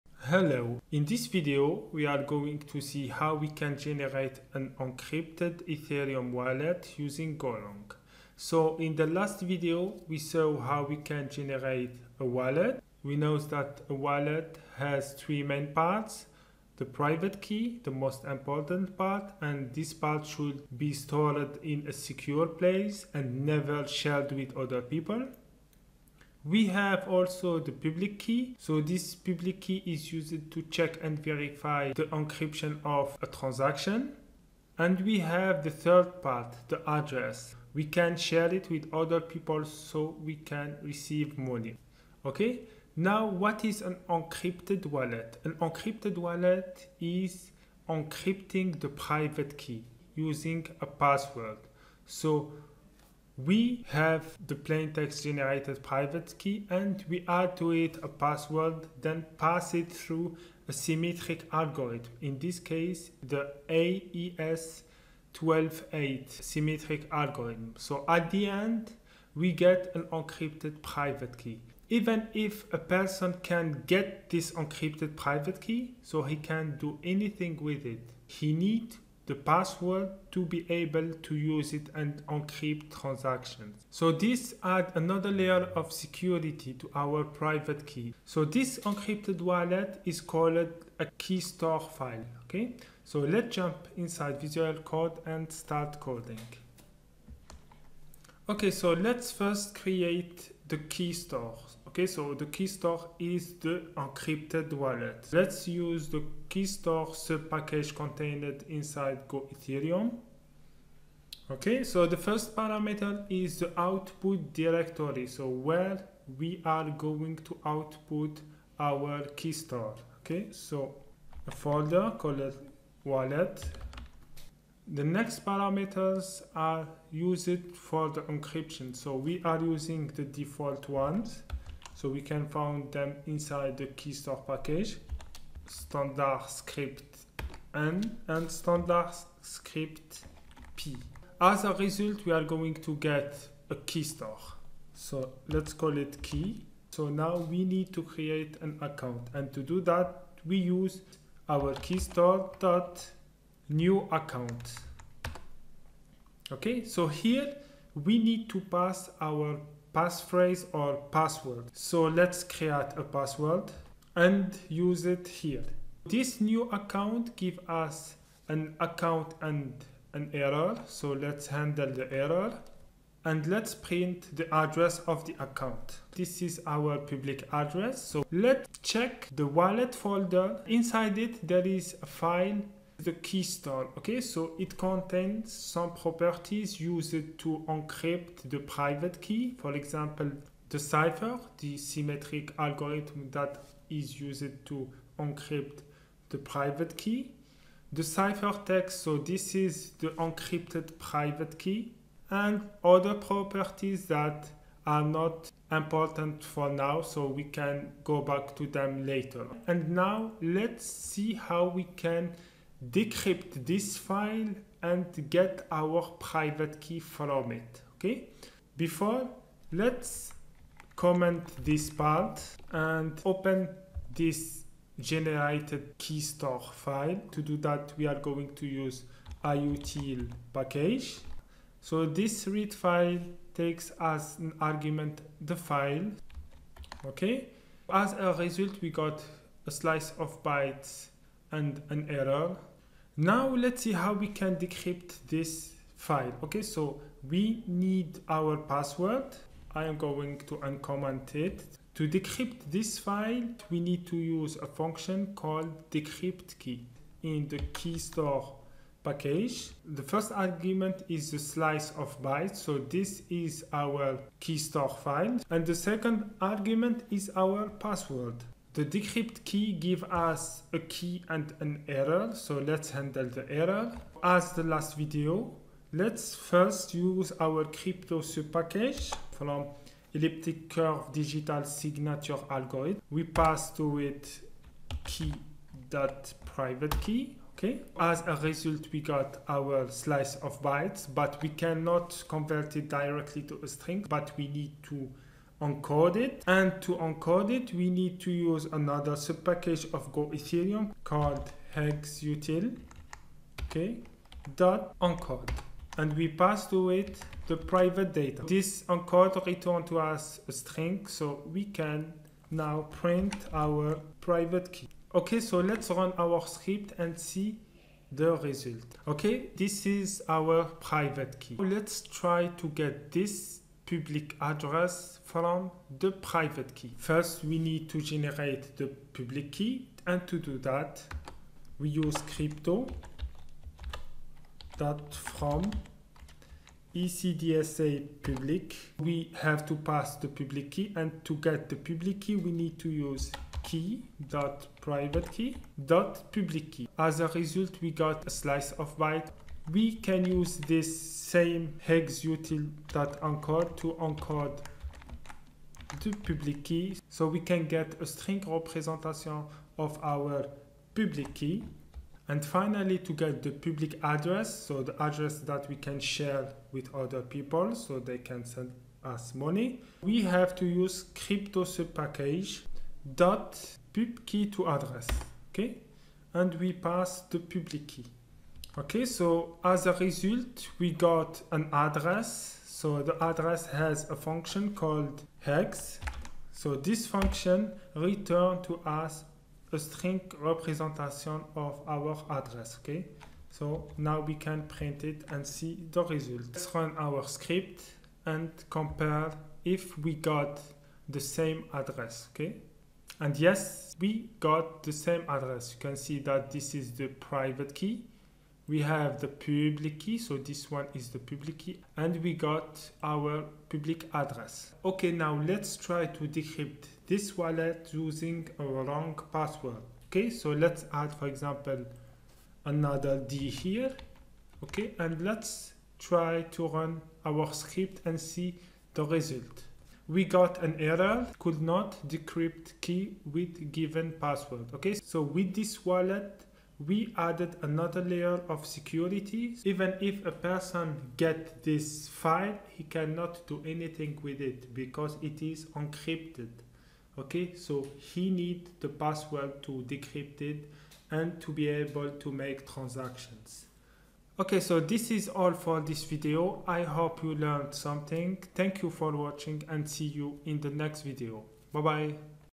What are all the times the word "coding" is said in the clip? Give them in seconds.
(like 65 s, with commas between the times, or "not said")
96 s.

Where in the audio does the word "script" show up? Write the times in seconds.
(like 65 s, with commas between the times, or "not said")
316 s, 397 s, 427 s.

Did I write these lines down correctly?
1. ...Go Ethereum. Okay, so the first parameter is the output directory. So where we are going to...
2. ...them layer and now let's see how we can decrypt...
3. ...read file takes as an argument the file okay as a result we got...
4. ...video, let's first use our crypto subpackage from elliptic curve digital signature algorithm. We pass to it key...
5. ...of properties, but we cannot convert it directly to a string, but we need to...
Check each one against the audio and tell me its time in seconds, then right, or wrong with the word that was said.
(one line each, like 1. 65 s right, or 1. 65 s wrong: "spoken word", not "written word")
1. 109 s right
2. 208 s wrong: "later", not "layer"
3. 232 s right
4. 274 s right
5. 290 s wrong: "bytes", not "properties".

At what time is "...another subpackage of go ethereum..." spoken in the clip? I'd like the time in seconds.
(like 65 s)
298 s.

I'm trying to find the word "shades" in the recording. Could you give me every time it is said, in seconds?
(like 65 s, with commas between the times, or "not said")
not said.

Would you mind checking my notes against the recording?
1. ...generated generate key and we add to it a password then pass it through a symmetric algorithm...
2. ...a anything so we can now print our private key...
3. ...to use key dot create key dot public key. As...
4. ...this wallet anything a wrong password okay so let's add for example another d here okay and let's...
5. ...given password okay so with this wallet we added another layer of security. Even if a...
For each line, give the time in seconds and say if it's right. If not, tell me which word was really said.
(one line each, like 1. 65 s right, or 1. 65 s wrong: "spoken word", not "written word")
1. 55 s wrong: "private", not "generate"
2. 310 s wrong: "string", not "anything"
3. 342 s wrong: "private", not "create"
4. 417 s wrong: "using", not "anything"
5. 433 s right.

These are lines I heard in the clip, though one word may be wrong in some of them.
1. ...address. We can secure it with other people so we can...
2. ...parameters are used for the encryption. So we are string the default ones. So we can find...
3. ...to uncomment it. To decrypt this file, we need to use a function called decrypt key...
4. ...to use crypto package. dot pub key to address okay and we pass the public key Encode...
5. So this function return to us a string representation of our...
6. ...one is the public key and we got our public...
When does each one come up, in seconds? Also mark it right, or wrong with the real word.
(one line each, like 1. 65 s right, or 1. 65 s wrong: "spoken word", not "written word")
1. 36 s wrong: "share", not "secure"
2. 125 s wrong: "using", not "string"
3. 250 s right
4. 370 s wrong: "Okay", not "Encode"
5. 386 s right
6. 410 s right.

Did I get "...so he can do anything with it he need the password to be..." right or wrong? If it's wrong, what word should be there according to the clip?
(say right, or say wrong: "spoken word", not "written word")
right.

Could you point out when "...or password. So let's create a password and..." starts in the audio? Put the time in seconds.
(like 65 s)
160 s.